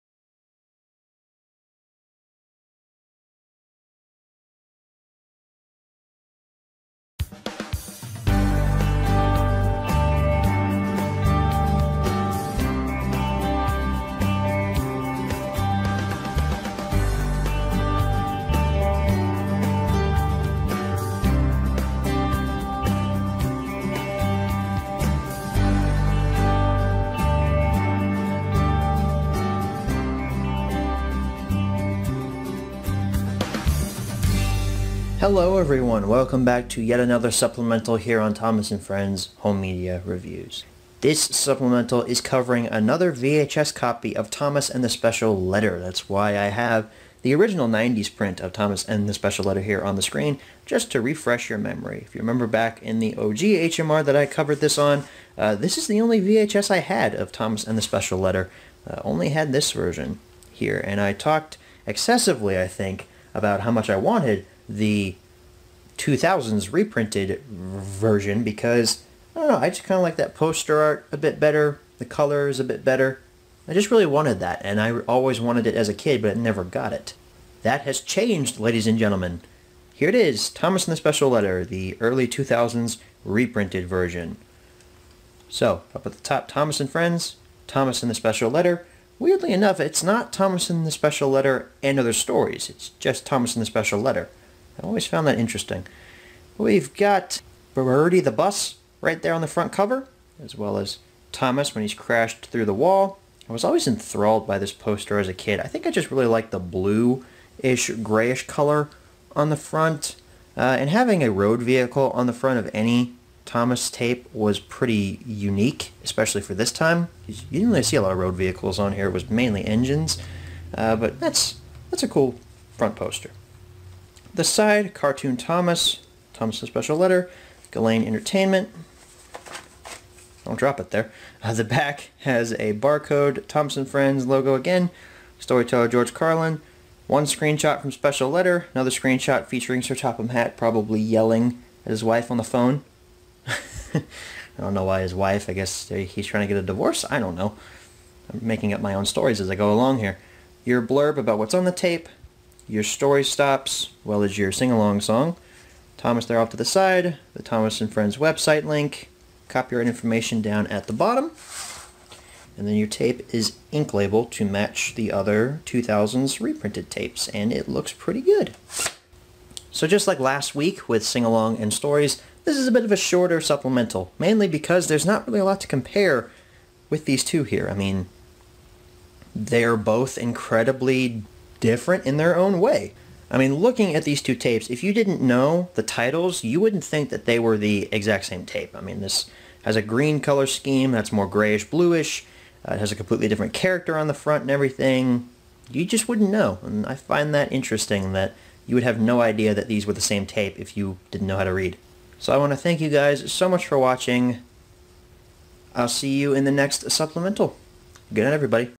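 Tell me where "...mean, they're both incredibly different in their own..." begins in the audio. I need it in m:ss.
2:57.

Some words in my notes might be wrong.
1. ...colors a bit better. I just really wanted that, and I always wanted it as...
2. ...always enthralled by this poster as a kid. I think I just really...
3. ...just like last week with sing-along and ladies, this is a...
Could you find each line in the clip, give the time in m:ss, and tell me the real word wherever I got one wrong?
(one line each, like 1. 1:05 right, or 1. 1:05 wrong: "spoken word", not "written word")
1. 1:12 right
2. 1:43 right
3. 2:49 wrong: "stories", not "ladies".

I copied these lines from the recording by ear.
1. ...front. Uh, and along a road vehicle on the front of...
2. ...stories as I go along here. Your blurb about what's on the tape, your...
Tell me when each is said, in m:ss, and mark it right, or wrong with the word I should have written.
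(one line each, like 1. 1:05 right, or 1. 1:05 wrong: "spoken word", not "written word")
1. 1:49 wrong: "having", not "along"
2. 2:29 right.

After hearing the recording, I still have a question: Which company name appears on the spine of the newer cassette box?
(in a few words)
Galane Entertainment.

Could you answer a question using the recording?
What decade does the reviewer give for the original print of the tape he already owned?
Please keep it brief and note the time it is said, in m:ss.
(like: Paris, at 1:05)
90s, at 0:47.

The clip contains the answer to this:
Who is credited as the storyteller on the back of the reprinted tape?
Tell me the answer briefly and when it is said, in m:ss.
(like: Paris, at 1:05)
George Carlin, at 2:15.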